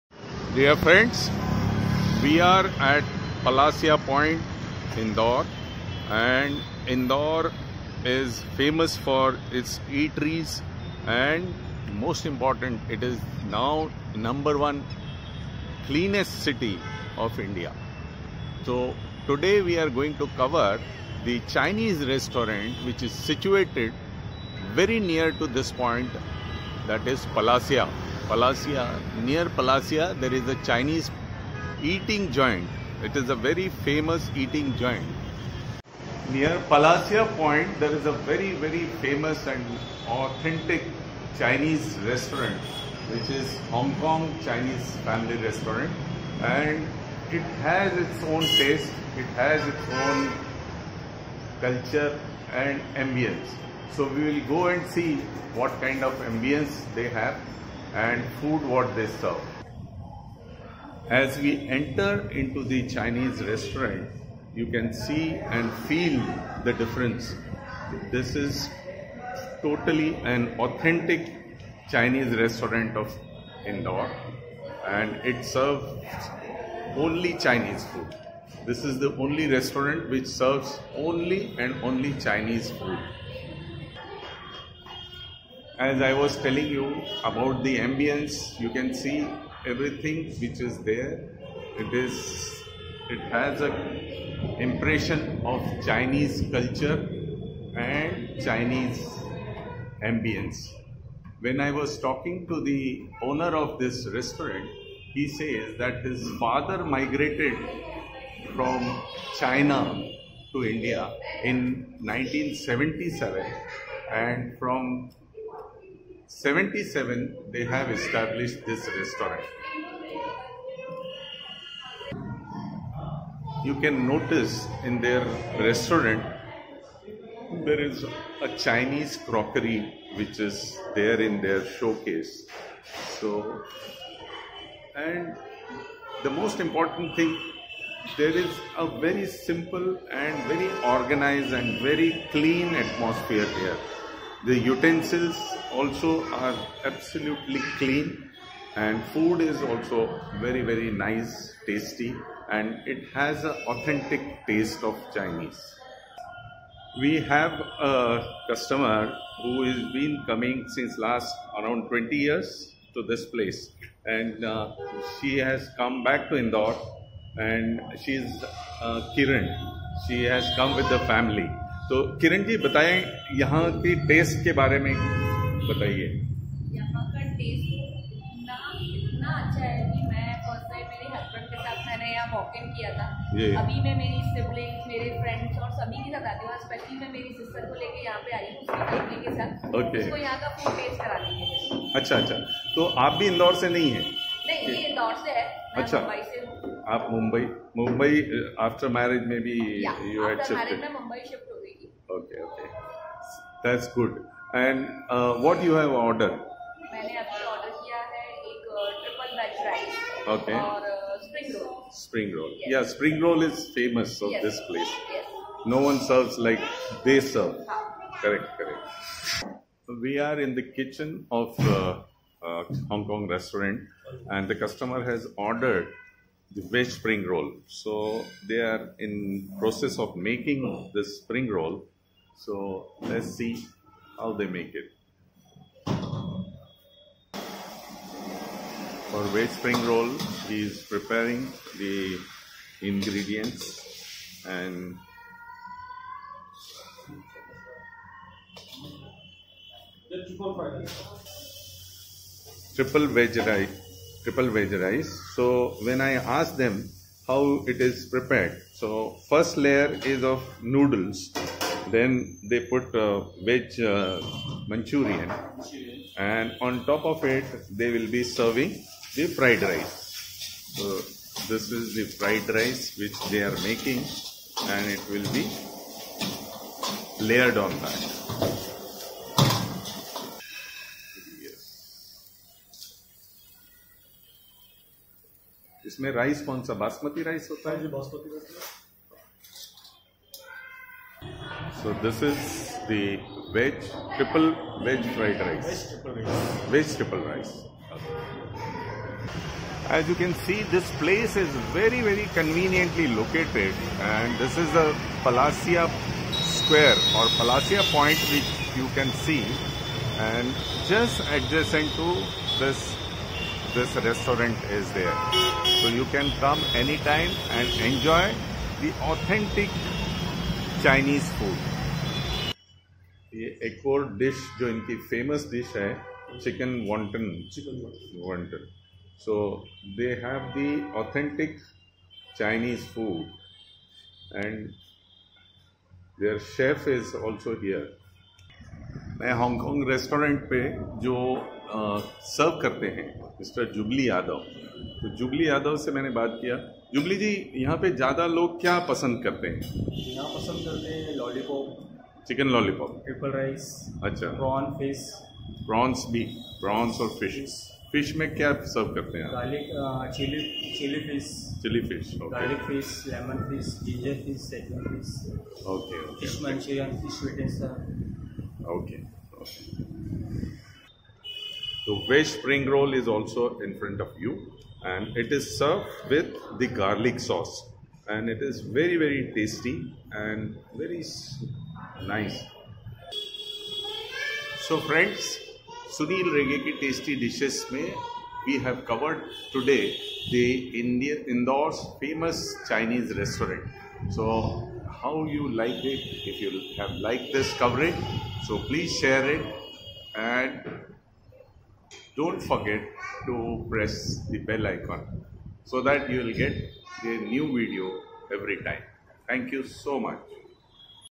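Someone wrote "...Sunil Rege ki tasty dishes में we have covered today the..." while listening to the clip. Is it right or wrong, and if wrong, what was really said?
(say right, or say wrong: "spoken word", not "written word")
right.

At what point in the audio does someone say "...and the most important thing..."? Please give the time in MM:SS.
02:14.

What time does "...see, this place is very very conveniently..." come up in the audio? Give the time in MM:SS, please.
05:00.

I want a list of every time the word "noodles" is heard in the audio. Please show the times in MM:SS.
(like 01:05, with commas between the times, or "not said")
04:20.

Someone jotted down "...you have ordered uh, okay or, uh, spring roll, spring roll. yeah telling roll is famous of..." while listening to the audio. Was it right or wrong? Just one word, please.
wrong.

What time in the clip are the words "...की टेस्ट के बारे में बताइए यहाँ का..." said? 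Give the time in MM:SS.
02:53.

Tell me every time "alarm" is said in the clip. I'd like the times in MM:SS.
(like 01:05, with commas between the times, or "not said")
not said.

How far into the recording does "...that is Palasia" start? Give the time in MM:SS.
00:26.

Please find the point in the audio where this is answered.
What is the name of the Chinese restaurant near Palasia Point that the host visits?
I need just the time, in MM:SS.
00:43.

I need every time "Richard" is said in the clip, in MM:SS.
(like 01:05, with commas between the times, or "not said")
not said.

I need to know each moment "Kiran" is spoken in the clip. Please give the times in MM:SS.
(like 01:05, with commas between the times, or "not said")
02:49.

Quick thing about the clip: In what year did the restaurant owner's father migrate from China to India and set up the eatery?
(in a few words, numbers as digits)
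1977.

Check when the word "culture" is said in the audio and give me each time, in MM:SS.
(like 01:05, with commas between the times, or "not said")
00:51, 01:36.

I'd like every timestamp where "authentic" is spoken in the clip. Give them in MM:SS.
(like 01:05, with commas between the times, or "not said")
00:40, 01:10, 02:33, 05:19.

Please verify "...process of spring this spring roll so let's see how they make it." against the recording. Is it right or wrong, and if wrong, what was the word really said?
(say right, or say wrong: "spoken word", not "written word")
wrong: "making", not "spring".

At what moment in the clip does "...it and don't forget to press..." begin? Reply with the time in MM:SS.
06:39.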